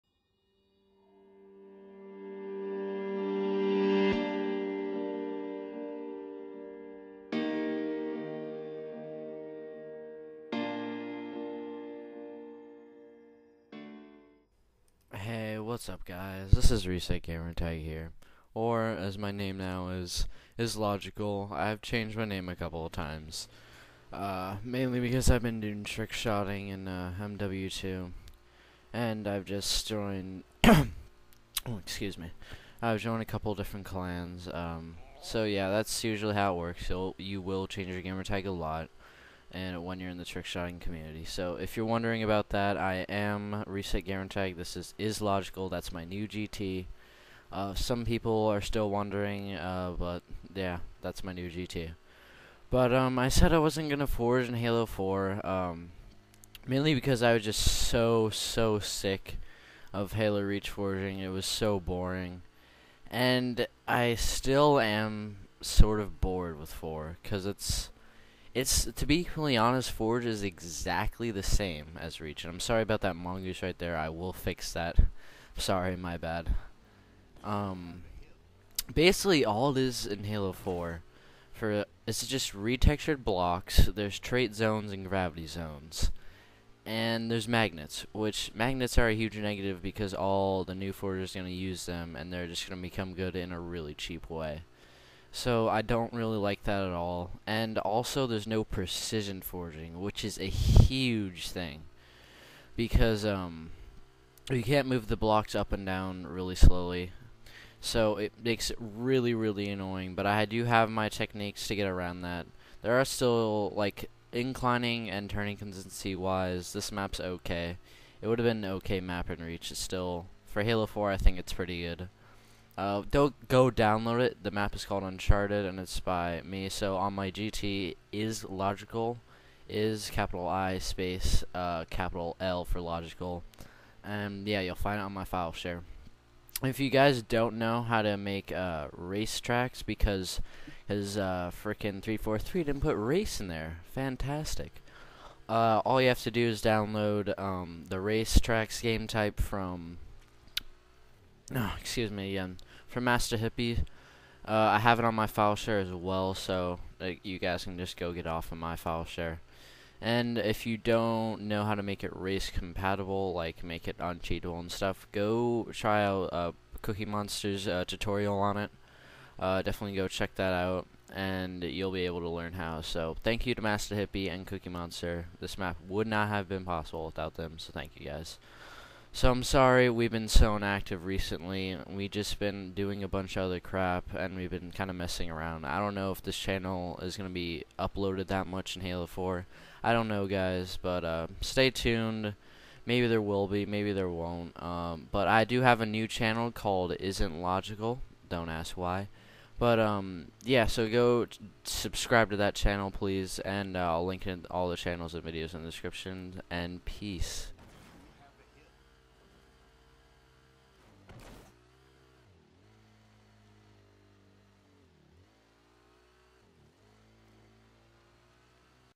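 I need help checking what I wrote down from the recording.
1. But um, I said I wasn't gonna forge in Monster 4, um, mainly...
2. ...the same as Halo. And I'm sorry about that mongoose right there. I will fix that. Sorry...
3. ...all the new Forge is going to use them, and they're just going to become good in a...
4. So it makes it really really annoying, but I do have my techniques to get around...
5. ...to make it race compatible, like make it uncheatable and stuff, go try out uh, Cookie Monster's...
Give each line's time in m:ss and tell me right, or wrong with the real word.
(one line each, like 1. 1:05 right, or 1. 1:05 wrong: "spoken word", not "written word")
1. 0:52 wrong: "Halo", not "Monster"
2. 1:11 wrong: "Reach", not "Halo"
3. 1:30 right
4. 1:47 right
5. 2:41 right.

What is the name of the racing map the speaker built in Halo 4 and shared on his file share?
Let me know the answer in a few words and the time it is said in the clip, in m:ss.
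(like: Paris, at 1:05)
Uncharted, at 2:05.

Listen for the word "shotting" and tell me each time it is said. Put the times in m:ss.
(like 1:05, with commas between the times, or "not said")
0:26, 0:40.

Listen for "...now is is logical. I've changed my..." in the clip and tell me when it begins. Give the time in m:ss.
0:19.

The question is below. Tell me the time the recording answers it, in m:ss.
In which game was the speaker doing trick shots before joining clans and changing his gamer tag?
0:27.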